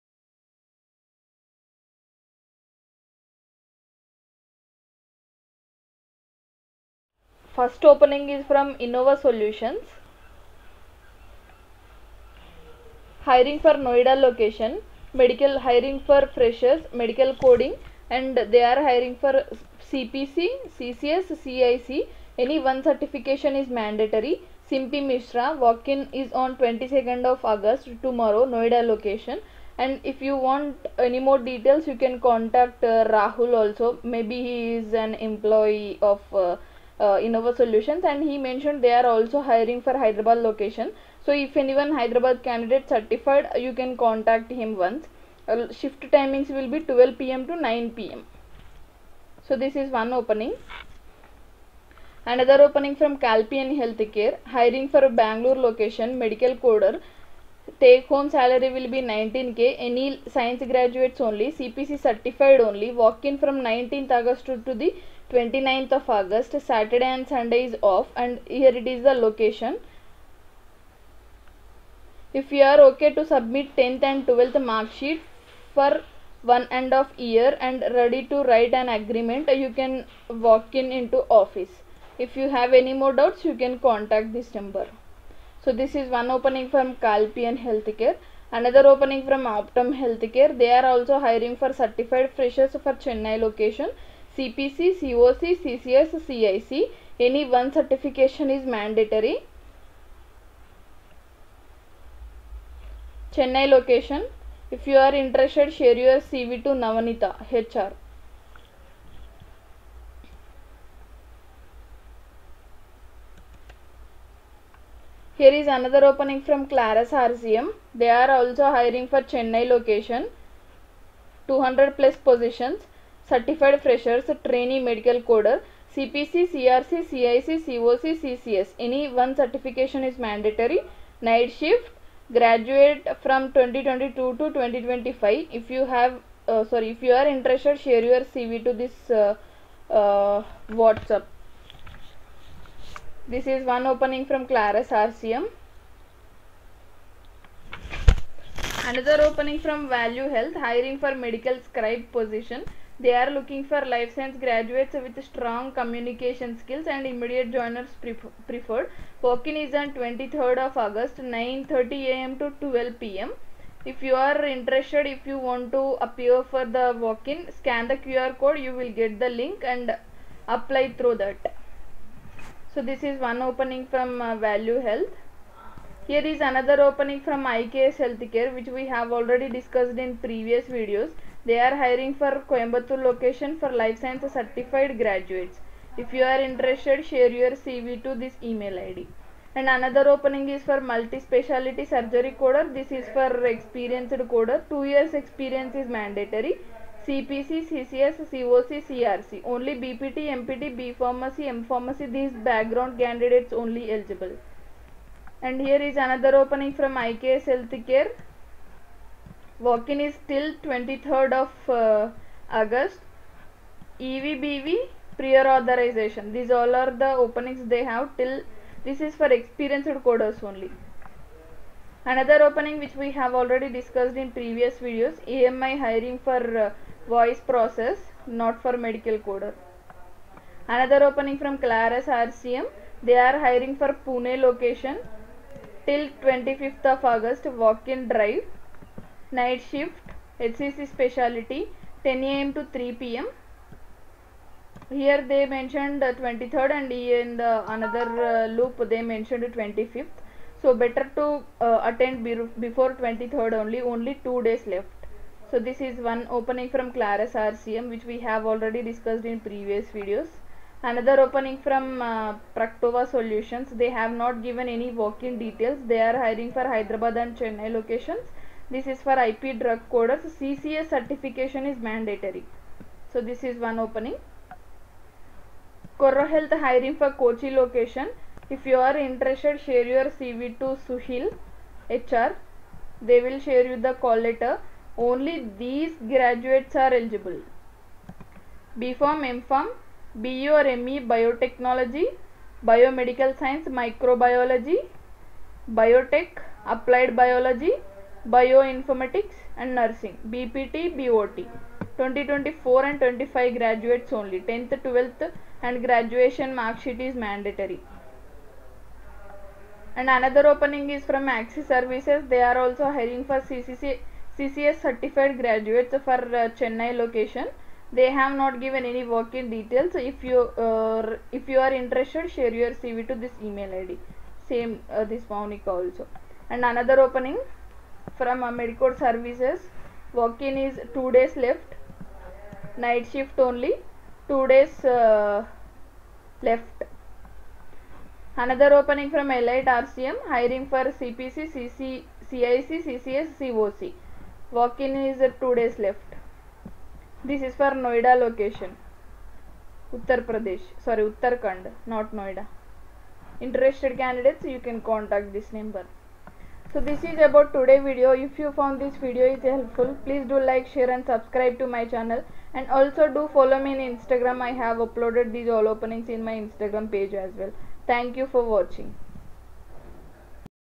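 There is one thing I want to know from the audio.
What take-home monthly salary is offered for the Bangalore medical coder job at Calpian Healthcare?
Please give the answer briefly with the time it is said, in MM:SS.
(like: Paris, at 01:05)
19k, at 00:59.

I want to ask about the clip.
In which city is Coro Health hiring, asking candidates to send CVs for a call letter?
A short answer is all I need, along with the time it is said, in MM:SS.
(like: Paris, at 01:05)
Kochi, at 04:37.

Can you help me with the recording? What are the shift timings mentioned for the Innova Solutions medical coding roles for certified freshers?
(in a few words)
12 pm to 9 pm.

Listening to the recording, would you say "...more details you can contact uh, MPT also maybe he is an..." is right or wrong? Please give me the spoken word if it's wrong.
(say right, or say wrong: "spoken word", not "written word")
wrong: "Rahul", not "MPT".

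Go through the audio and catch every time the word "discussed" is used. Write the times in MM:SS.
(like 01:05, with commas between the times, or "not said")
02:59, 03:43, 04:18.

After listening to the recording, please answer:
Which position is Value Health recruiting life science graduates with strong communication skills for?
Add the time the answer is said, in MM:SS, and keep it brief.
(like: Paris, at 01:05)
Medical scribe, at 02:31.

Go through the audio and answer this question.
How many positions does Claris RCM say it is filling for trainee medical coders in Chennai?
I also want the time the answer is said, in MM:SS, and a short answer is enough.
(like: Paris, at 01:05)
200 plus, at 02:01.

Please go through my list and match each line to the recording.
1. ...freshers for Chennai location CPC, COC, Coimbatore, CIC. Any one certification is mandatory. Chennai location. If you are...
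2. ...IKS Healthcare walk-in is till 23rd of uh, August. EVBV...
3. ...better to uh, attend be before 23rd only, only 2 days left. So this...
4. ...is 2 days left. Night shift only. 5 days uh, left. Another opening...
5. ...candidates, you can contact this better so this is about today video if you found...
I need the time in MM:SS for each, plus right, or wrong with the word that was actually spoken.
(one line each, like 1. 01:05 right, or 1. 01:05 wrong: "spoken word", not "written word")
1. 01:32 wrong: "CCS", not "Coimbatore"
2. 03:26 right
3. 04:10 right
4. 05:30 wrong: "2", not "5"
5. 05:53 wrong: "number", not "better".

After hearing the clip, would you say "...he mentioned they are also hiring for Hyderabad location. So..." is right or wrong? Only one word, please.
right.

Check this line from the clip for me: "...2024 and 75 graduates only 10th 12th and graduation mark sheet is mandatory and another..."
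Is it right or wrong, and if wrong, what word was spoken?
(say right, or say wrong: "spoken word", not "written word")
wrong: "25", not "75".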